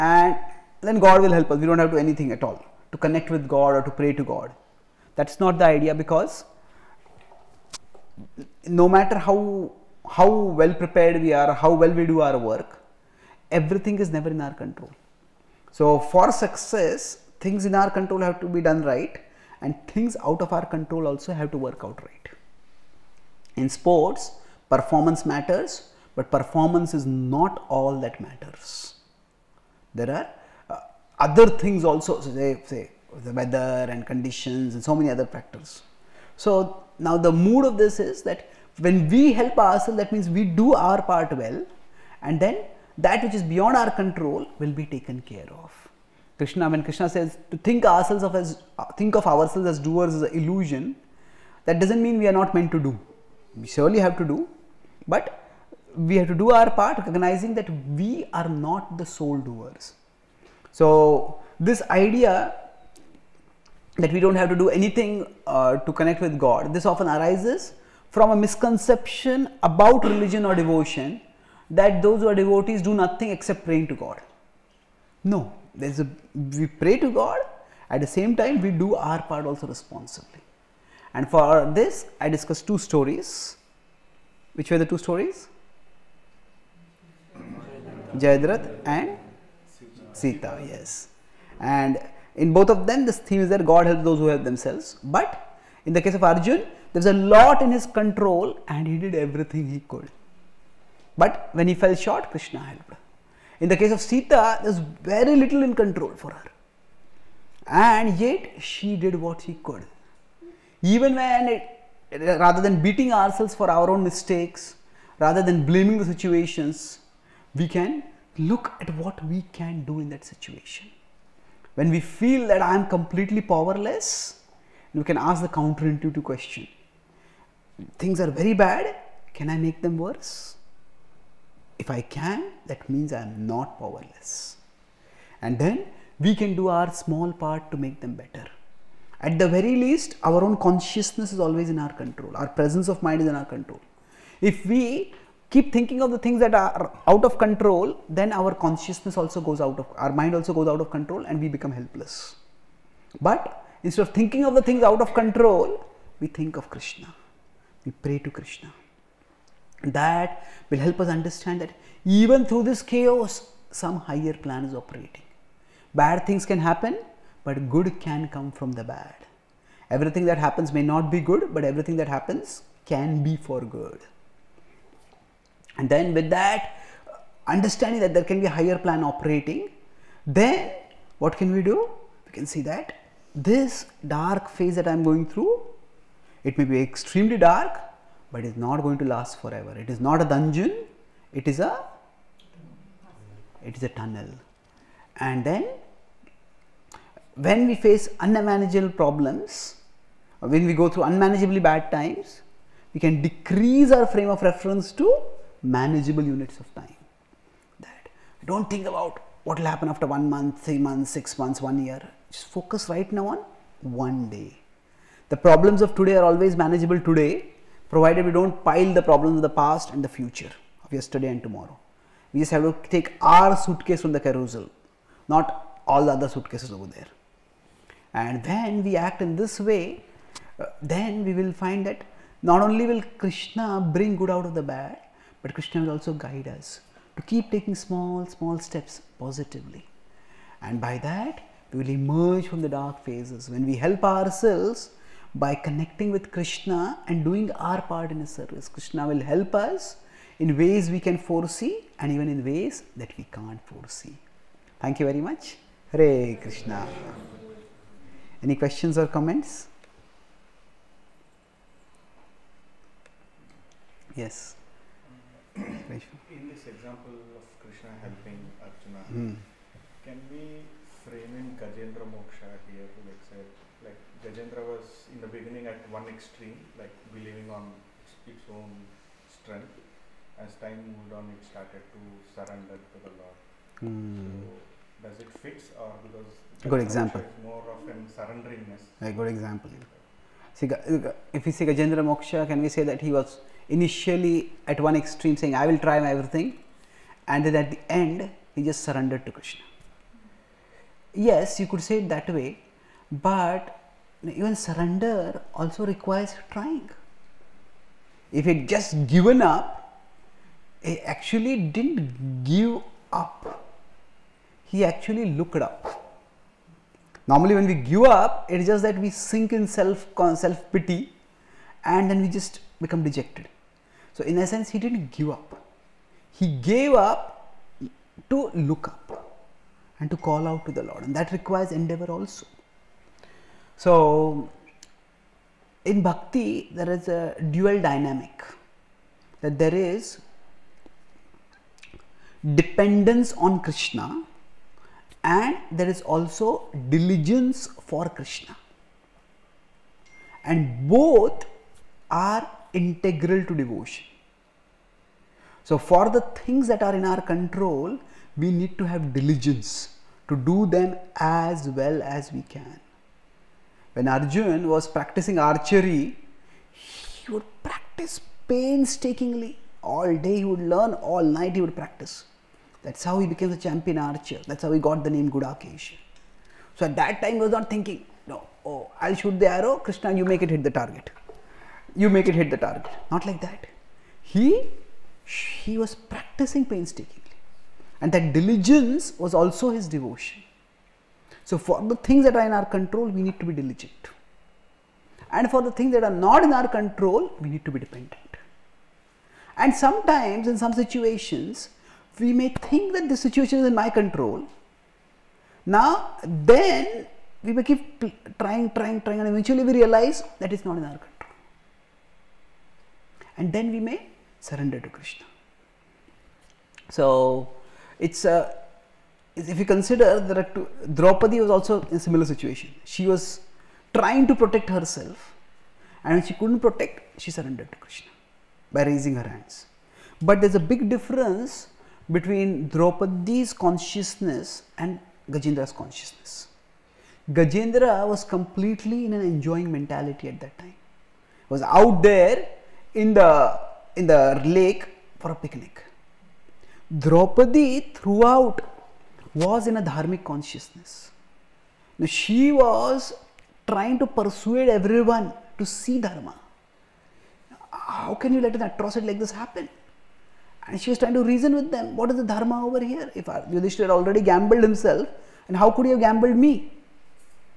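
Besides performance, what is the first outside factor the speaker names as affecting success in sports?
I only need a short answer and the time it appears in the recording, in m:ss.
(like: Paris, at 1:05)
The weather, at 0:33.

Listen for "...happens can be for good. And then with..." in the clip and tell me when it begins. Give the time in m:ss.
2:52.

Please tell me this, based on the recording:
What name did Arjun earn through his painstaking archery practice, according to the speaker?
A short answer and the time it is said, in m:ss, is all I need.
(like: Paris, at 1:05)
Gudakesh, at 6:15.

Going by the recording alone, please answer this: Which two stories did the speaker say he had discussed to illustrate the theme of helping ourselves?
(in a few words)
Jayadrath and Sita.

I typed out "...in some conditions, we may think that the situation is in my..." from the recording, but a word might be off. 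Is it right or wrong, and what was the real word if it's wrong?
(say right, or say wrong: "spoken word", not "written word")
wrong: "situations", not "conditions".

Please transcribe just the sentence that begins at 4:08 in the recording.
Krishna will help us in ways we can foresee and even in ways that we can't foresee.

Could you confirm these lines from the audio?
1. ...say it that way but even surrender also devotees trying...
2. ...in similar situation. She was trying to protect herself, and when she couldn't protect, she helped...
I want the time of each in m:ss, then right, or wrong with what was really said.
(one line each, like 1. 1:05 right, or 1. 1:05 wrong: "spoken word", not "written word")
1. 5:01 wrong: "requires", not "devotees"
2. 7:01 wrong: "surrendered", not "helped".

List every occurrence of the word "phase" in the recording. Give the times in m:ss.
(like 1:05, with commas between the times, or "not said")
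3:04, 4:03.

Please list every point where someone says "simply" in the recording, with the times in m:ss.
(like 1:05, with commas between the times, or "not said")
not said.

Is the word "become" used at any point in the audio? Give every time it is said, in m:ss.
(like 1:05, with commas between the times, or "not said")
2:31, 5:22.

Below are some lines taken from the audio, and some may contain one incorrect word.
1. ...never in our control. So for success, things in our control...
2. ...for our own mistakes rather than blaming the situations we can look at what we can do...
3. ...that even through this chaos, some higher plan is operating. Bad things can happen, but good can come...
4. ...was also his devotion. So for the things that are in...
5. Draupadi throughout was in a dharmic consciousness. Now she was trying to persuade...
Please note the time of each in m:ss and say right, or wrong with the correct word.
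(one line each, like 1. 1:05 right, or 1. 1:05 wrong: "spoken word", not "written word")
1. 0:14 right
2. 1:53 right
3. 2:41 right
4. 6:29 right
5. 7:27 right.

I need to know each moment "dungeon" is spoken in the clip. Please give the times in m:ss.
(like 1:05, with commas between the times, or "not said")
3:10.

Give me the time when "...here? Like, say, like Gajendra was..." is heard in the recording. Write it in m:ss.
4:32.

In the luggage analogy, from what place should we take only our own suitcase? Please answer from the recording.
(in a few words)
The carousel.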